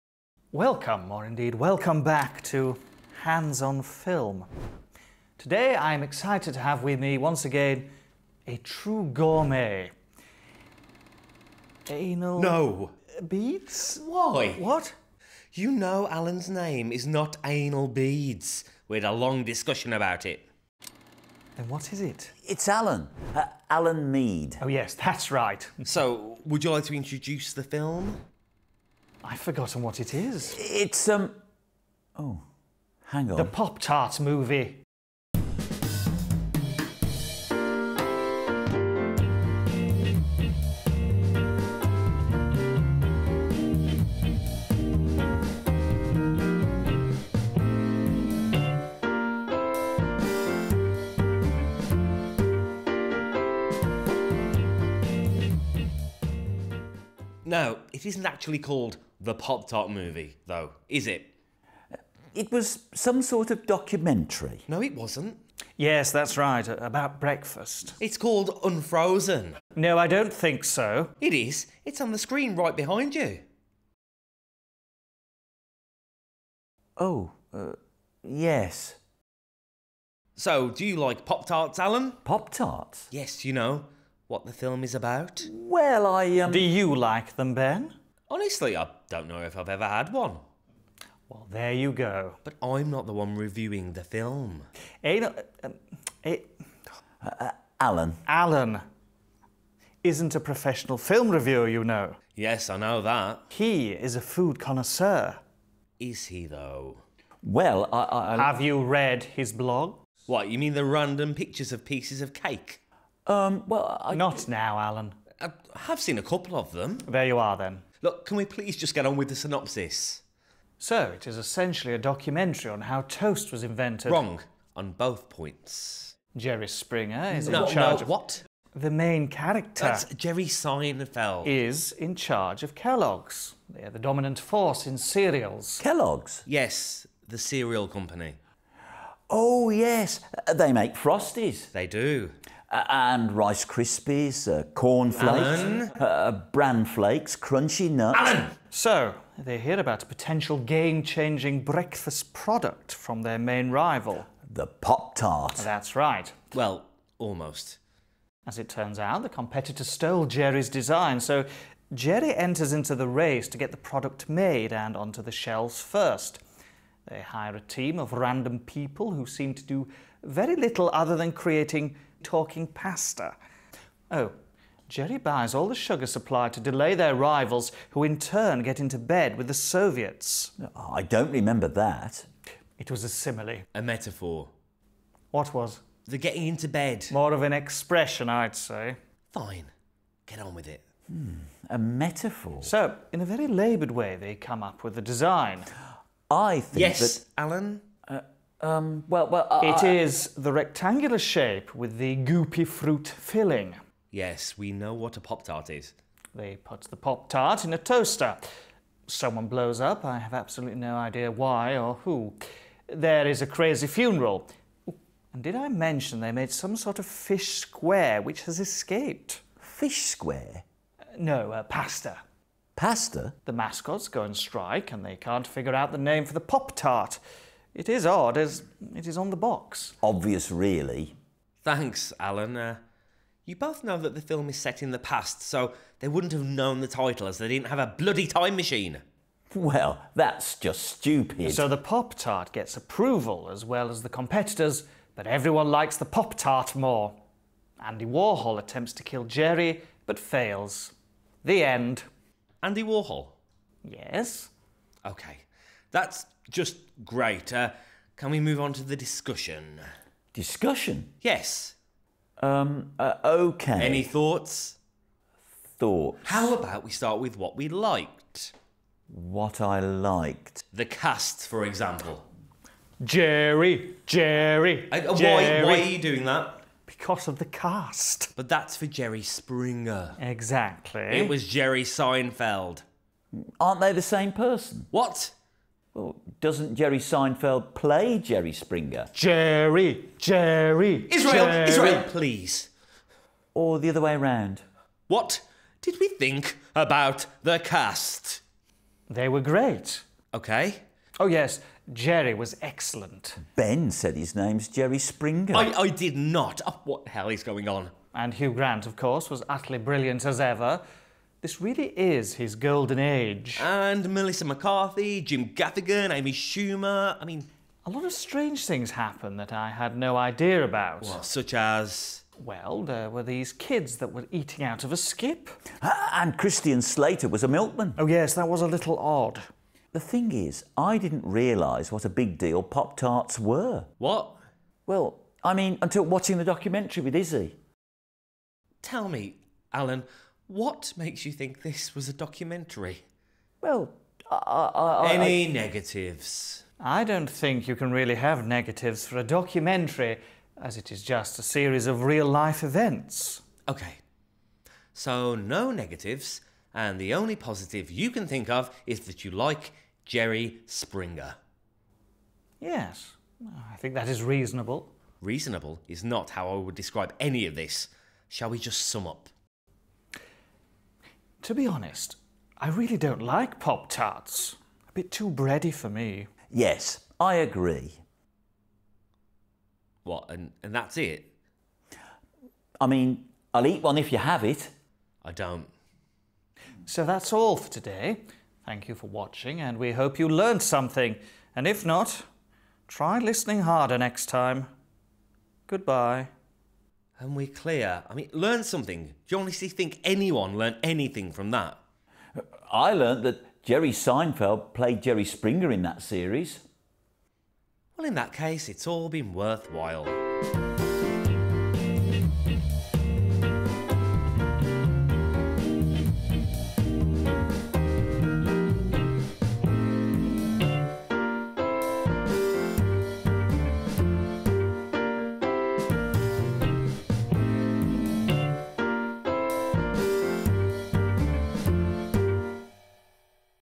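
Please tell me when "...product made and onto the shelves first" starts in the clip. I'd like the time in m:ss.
2:43.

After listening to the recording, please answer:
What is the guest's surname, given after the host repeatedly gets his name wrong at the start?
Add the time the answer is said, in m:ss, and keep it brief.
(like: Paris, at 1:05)
Mead, at 0:24.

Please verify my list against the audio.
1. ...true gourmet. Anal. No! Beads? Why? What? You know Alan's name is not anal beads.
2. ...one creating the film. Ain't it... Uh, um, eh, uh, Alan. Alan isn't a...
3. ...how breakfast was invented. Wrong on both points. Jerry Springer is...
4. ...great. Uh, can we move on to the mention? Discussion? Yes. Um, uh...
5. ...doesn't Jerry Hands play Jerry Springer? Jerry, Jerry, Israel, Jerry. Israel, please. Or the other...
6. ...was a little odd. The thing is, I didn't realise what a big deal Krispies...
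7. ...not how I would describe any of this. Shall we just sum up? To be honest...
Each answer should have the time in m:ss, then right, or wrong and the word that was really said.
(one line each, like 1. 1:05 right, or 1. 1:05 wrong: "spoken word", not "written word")
1. 0:08 right
2. 1:33 wrong: "reviewing", not "creating"
3. 2:02 wrong: "toast", not "breakfast"
4. 4:17 wrong: "discussion", not "mention"
5. 4:46 wrong: "Seinfeld", not "Hands"
6. 5:28 wrong: "Pop", not "Krispies"
7. 6:06 right.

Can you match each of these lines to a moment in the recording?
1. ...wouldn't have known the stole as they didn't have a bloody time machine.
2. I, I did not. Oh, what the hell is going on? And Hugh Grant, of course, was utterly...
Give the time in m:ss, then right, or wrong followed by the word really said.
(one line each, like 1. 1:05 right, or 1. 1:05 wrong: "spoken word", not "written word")
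1. 3:56 wrong: "title", not "stole"
2. 5:05 right.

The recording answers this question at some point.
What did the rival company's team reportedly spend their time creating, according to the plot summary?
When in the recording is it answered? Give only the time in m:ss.
2:52.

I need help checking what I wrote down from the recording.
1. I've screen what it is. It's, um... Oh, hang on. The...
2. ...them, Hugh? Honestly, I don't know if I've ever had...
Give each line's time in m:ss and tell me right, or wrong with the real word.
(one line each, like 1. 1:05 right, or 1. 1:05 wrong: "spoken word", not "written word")
1. 0:29 wrong: "forgotten", not "screen"
2. 1:27 wrong: "Ben", not "Hugh".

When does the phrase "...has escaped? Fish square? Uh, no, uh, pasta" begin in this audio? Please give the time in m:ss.
3:38.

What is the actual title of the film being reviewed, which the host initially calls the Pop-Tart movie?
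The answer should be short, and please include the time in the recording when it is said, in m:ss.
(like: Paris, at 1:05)
Unfrozen, at 1:08.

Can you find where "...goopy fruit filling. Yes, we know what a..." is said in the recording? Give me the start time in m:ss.
3:22.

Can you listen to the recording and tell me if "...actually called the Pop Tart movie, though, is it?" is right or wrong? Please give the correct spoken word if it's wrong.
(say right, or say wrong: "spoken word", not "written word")
right.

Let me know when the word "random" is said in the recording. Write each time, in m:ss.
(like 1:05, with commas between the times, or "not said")
1:50, 2:48.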